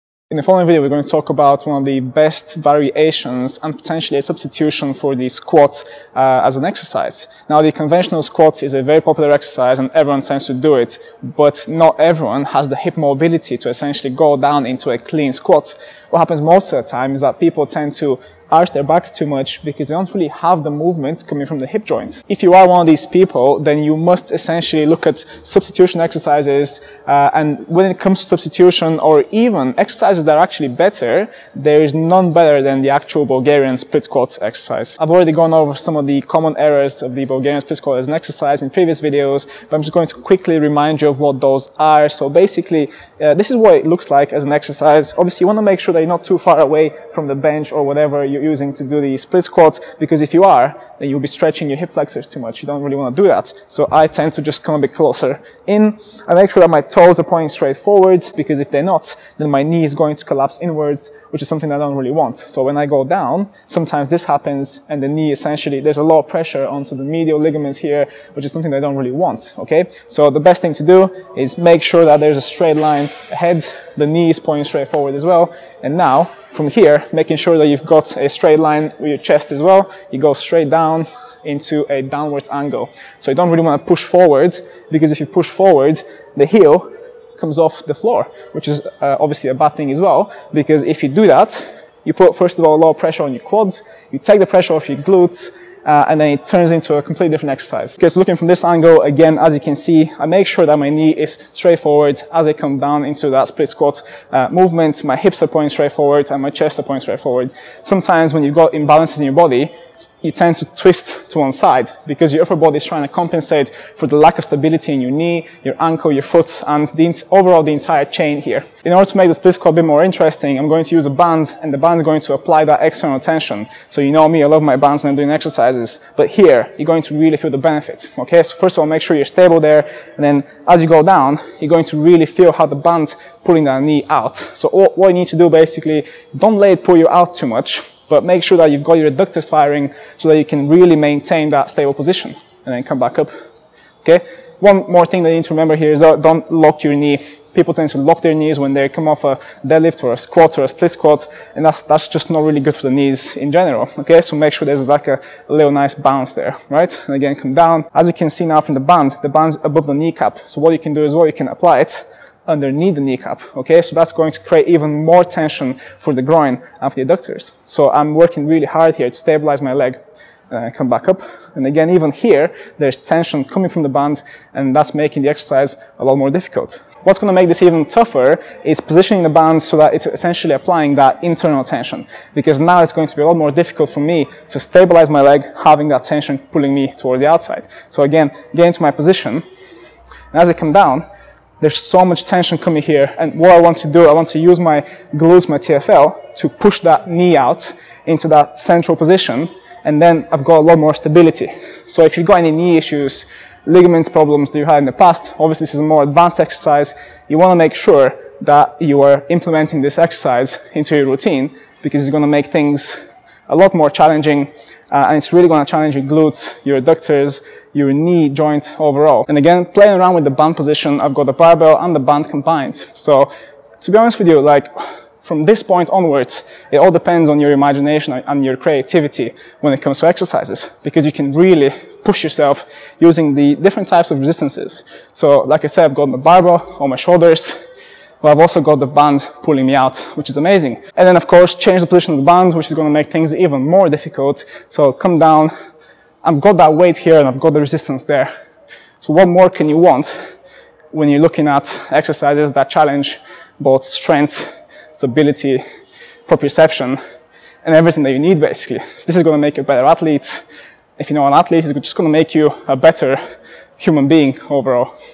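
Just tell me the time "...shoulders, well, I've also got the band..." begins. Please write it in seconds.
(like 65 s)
236 s.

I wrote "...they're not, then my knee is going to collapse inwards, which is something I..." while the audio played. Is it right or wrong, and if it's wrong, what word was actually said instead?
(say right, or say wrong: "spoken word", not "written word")
right.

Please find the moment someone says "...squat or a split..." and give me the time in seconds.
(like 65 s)
150 s.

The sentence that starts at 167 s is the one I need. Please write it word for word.
So I'm working really hard here to stabilize my leg and uh, come back up.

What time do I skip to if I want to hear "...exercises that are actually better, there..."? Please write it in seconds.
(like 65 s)
29 s.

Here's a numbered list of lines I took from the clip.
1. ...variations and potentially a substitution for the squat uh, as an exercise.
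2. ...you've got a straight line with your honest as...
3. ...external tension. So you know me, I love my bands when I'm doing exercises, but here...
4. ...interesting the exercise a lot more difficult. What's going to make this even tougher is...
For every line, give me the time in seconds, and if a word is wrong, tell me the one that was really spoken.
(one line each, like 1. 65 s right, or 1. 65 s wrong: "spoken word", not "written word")
1. 2 s right
2. 77 s wrong: "chest", not "honest"
3. 122 s right
4. 174 s wrong: "making", not "interesting".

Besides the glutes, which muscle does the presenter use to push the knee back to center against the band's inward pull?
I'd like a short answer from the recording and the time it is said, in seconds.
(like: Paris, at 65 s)
TFL, at 195 s.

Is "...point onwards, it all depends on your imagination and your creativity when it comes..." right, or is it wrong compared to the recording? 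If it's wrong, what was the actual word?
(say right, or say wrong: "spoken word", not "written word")
right.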